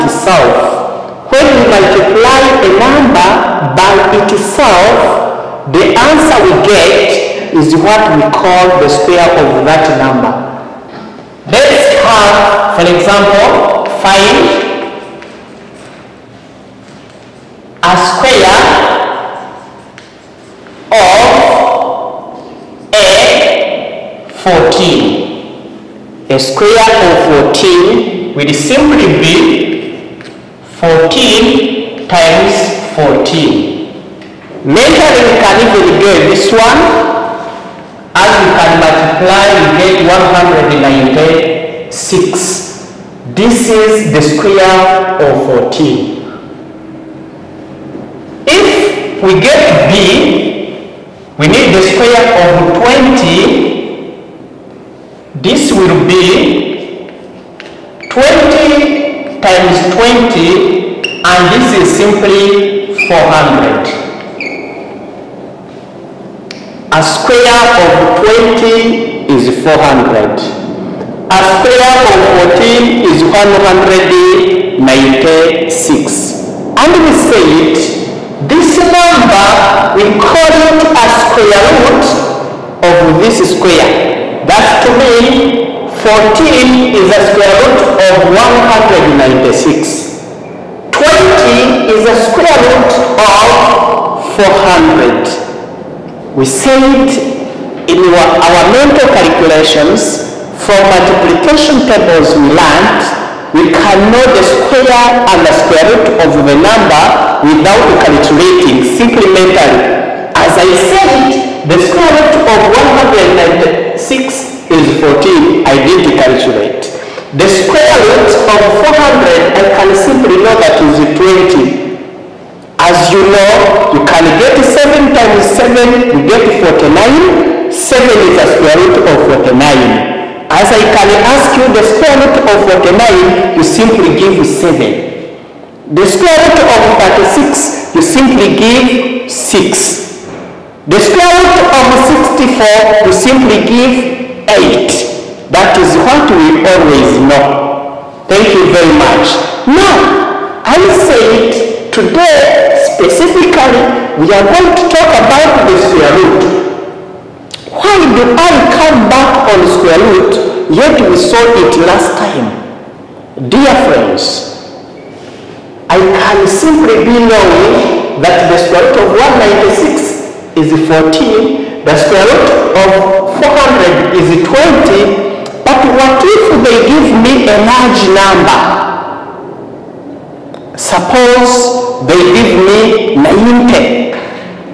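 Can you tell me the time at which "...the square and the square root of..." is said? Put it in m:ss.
1:44.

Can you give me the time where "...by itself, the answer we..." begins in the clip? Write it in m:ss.
0:03.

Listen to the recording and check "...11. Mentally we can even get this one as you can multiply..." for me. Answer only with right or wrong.
wrong.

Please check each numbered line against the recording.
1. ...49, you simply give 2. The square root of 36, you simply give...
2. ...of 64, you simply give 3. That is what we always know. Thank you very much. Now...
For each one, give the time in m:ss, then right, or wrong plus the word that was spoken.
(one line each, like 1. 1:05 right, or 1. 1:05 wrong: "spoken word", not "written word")
1. 2:12 wrong: "7", not "2"
2. 2:21 wrong: "8", not "3".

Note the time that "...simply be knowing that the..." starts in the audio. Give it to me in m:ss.
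2:46.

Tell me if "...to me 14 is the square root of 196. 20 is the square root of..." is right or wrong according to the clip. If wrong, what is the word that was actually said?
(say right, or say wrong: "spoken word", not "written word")
right.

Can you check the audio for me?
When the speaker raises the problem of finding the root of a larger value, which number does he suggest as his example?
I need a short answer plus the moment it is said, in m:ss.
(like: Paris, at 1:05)
90, at 3:03.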